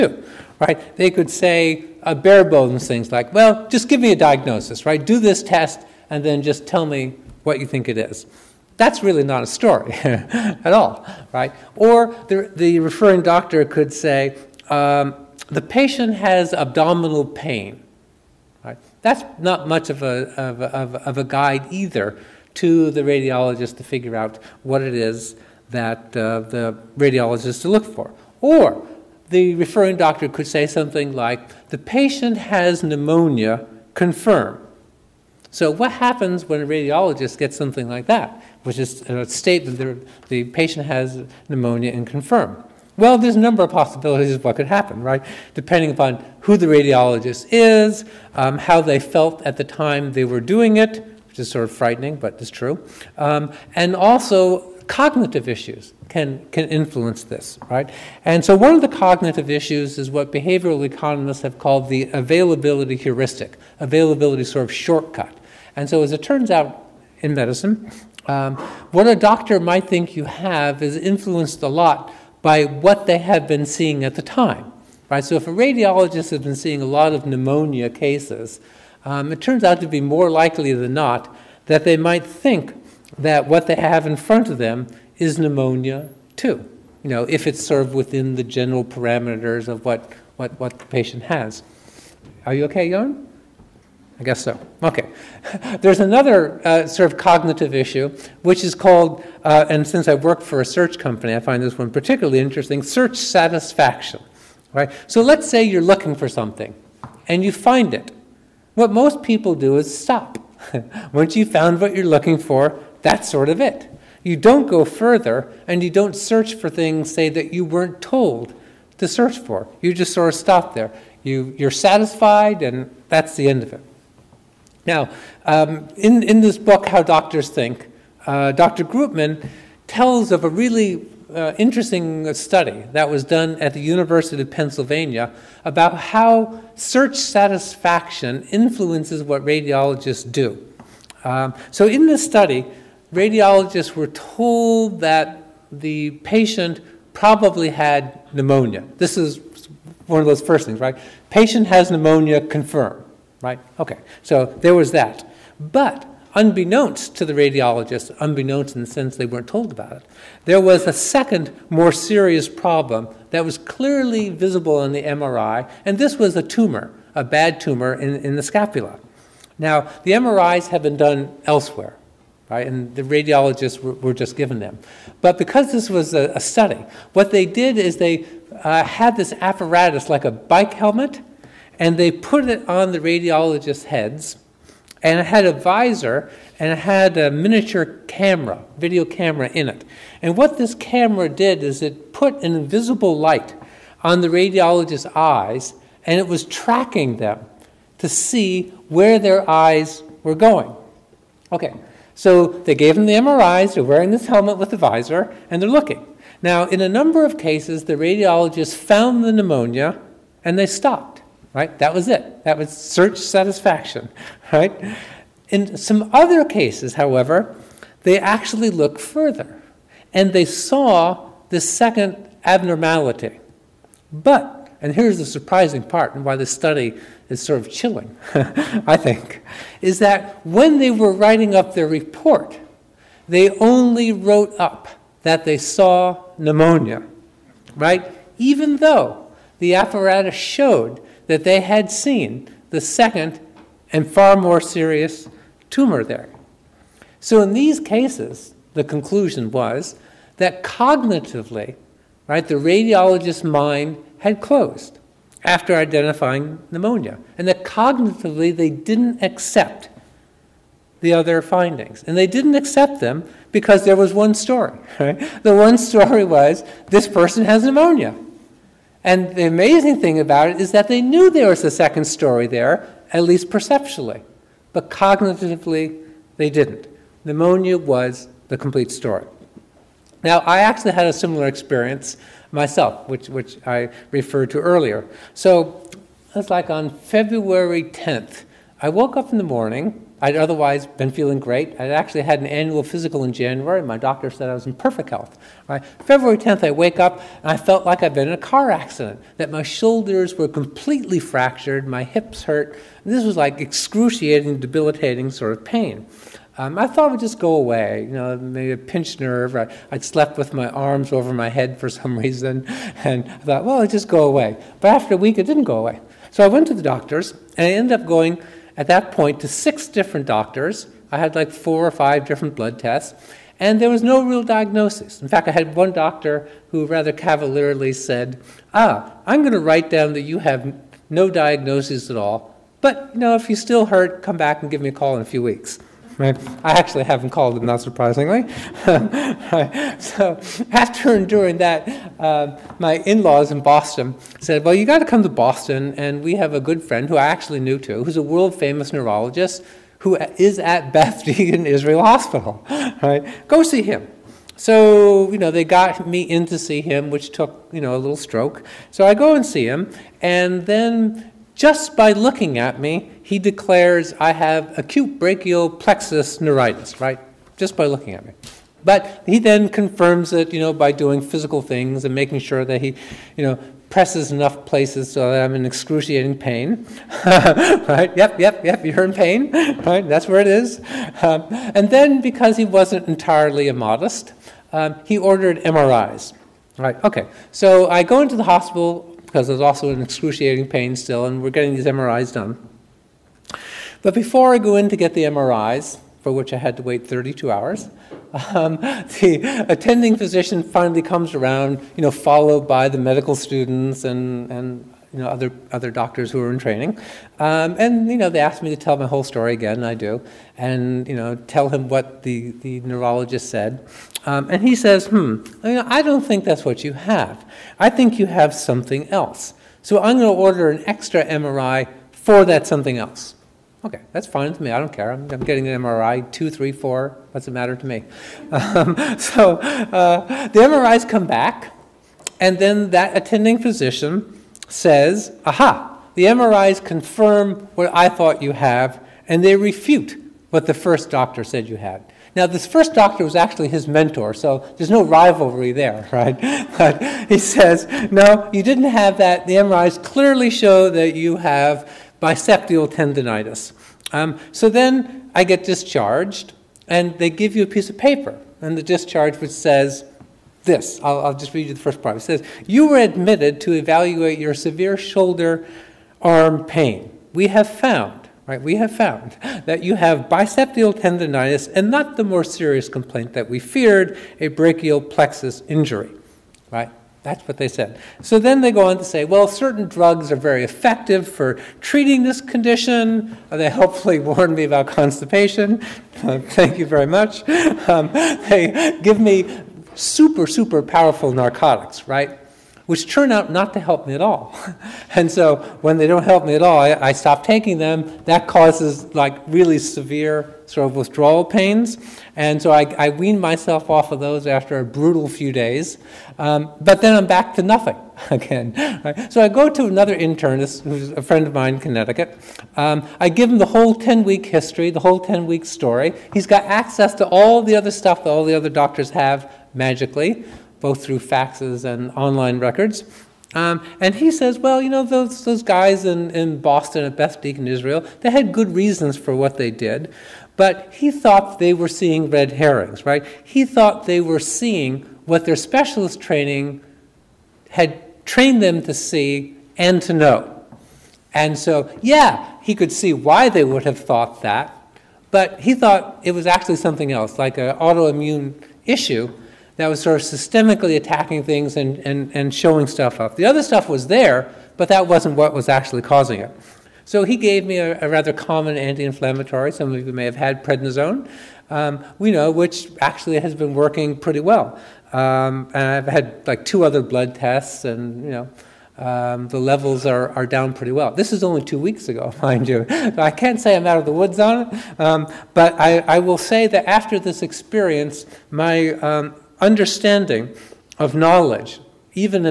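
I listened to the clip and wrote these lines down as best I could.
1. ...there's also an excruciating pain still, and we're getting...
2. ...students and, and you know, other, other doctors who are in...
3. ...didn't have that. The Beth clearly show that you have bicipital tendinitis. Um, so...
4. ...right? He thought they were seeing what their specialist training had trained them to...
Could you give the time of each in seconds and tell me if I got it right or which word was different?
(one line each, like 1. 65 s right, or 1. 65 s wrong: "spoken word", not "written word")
1. 389 s right
2. 403 s right
3. 448 s wrong: "MRIs", not "Beth"
4. 533 s right.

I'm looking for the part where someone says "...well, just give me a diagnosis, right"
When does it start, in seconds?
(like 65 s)
3 s.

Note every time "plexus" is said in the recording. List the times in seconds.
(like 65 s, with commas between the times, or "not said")
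365 s, 475 s.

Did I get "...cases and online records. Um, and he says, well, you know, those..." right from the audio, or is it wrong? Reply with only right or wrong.
wrong.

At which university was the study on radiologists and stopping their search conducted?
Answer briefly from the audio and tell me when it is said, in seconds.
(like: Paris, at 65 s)
University of Pennsylvania, at 133 s.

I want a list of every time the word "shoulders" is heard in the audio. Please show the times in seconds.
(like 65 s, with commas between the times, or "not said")
299 s, 464 s.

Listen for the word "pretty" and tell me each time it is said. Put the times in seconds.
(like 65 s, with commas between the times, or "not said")
564 s, 570 s.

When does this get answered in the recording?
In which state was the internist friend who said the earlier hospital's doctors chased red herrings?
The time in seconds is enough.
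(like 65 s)
511 s.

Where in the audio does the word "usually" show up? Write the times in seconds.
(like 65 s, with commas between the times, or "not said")
not said.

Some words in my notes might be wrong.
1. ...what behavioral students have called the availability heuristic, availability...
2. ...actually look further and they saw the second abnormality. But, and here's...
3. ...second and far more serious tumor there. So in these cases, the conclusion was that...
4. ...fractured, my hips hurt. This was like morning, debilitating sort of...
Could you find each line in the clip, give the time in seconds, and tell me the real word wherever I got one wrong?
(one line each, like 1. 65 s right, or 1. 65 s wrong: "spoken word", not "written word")
1. 60 s wrong: "economists", not "students"
2. 218 s right
3. 242 s right
4. 301 s wrong: "excruciating", not "morning".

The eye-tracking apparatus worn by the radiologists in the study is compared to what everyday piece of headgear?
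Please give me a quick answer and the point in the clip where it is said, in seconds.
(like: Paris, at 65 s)
bike helmet, at 180 s.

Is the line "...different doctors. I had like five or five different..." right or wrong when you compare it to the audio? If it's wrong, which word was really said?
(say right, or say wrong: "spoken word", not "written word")
wrong: "four", not "five".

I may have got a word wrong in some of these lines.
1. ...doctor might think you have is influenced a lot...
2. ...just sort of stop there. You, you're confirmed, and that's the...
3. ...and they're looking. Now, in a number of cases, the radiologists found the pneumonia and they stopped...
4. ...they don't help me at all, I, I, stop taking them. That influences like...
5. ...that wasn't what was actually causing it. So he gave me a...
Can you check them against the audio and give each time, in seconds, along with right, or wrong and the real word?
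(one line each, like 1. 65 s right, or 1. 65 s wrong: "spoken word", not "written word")
1. 69 s right
2. 119 s wrong: "satisfied", not "confirmed"
3. 205 s right
4. 495 s wrong: "causes", not "influences"
5. 554 s right.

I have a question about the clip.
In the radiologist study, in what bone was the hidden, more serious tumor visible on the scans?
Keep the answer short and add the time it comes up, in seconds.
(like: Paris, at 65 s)
scapula, at 168 s.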